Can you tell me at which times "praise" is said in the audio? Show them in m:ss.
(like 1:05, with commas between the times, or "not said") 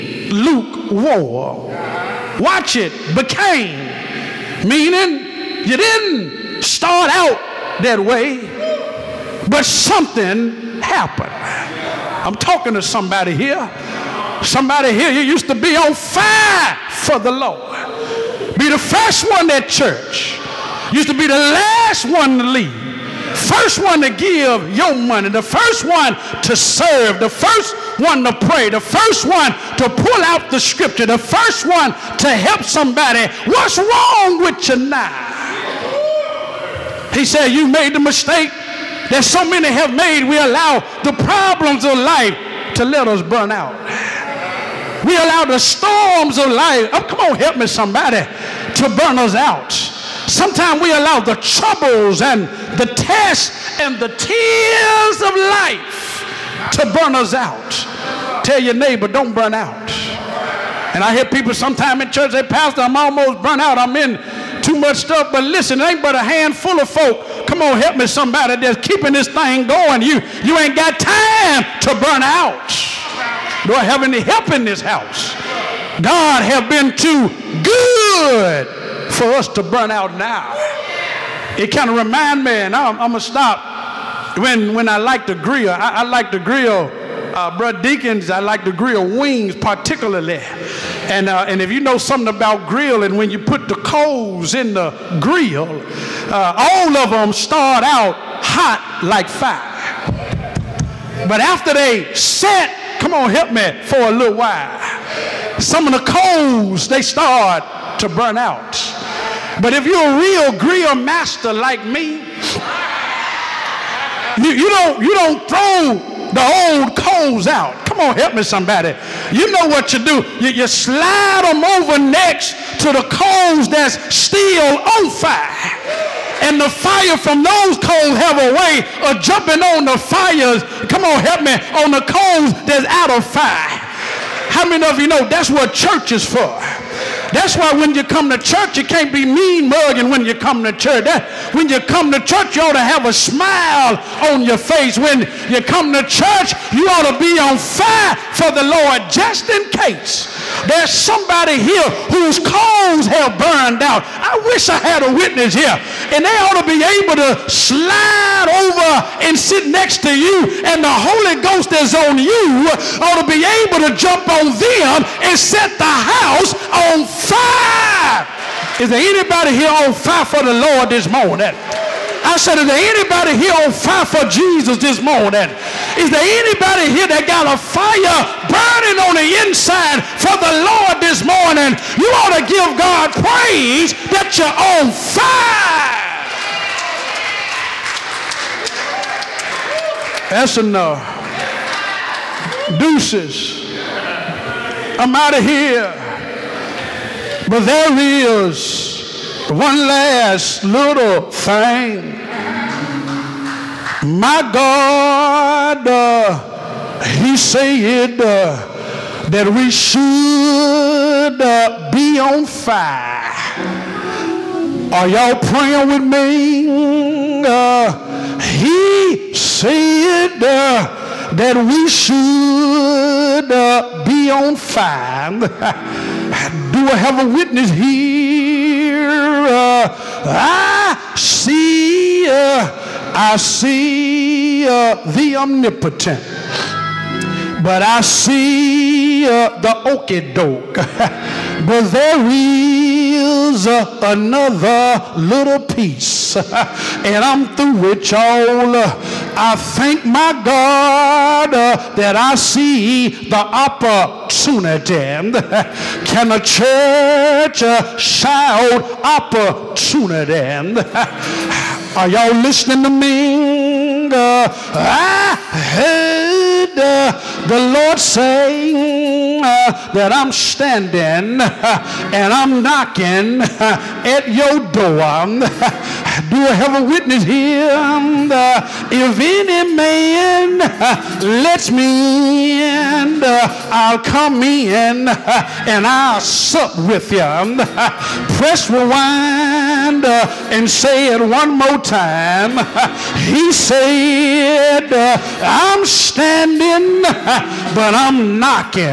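3:03.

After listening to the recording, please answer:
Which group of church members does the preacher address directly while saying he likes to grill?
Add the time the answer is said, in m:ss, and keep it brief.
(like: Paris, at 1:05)
Deacons, at 1:27.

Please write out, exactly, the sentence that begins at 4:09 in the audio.
I thank my God uh, that I see the opportunity.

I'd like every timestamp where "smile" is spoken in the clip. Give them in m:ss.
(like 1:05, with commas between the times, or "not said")
2:23.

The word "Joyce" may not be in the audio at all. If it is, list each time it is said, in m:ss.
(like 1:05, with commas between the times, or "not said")
not said.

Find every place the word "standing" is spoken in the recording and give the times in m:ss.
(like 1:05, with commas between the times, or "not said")
4:30, 4:55.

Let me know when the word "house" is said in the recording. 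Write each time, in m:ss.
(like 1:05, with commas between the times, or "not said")
1:14, 2:45.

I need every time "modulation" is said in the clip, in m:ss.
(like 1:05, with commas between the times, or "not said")
not said.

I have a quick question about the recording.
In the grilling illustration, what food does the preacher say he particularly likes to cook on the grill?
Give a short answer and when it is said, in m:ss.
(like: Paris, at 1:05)
wings, at 1:29.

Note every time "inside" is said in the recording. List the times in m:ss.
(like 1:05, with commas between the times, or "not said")
2:59.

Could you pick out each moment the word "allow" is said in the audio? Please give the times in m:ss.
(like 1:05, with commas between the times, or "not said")
0:40, 0:45, 0:50.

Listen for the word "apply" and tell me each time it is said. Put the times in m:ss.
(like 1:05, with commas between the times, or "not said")
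not said.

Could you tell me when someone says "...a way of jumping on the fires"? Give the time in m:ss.
2:08.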